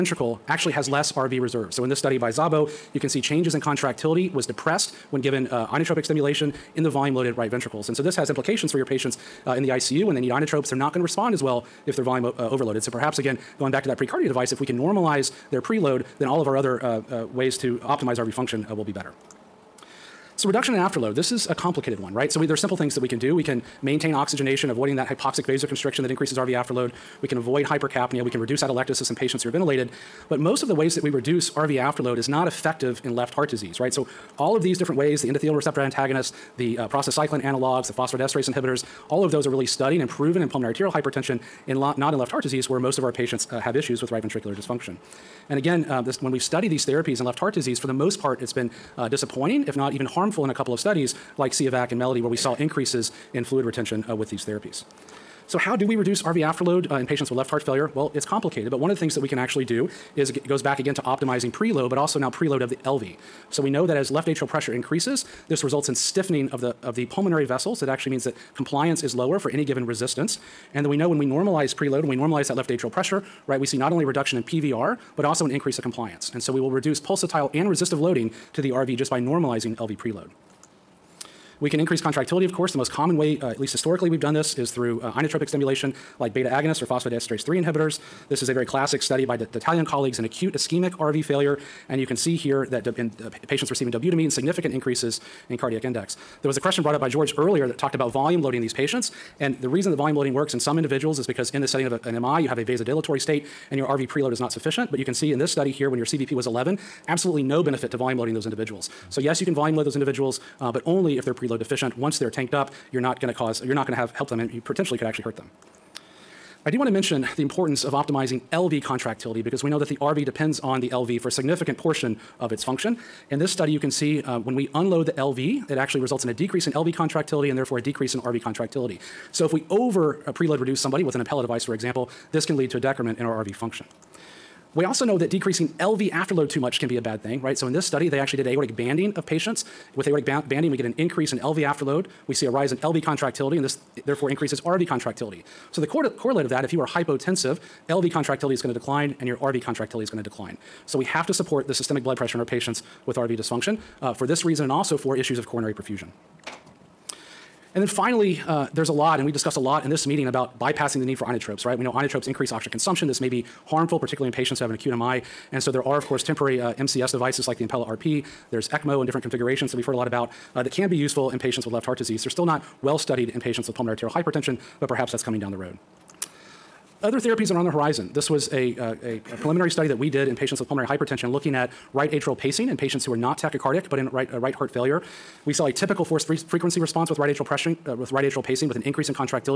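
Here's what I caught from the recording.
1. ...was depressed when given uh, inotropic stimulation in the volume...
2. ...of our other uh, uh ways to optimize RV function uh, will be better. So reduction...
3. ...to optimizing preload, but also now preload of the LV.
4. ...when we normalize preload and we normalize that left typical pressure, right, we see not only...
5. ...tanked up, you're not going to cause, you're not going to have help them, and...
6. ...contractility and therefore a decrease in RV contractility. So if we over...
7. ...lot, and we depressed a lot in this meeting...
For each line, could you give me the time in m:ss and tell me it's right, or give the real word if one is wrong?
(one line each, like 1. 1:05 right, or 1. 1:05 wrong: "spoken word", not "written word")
1. 0:04 right
2. 0:16 right
3. 1:00 right
4. 1:11 wrong: "atrial", not "typical"
5. 1:52 right
6. 2:06 right
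7. 2:38 wrong: "discussed", not "depressed".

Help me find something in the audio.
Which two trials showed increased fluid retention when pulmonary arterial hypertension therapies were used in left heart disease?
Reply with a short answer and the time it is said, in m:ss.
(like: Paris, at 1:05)
SIOVAC and Melody, at 0:51.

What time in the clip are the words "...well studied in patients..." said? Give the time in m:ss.
2:52.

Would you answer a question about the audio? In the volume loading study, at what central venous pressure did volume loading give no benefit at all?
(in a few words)
11.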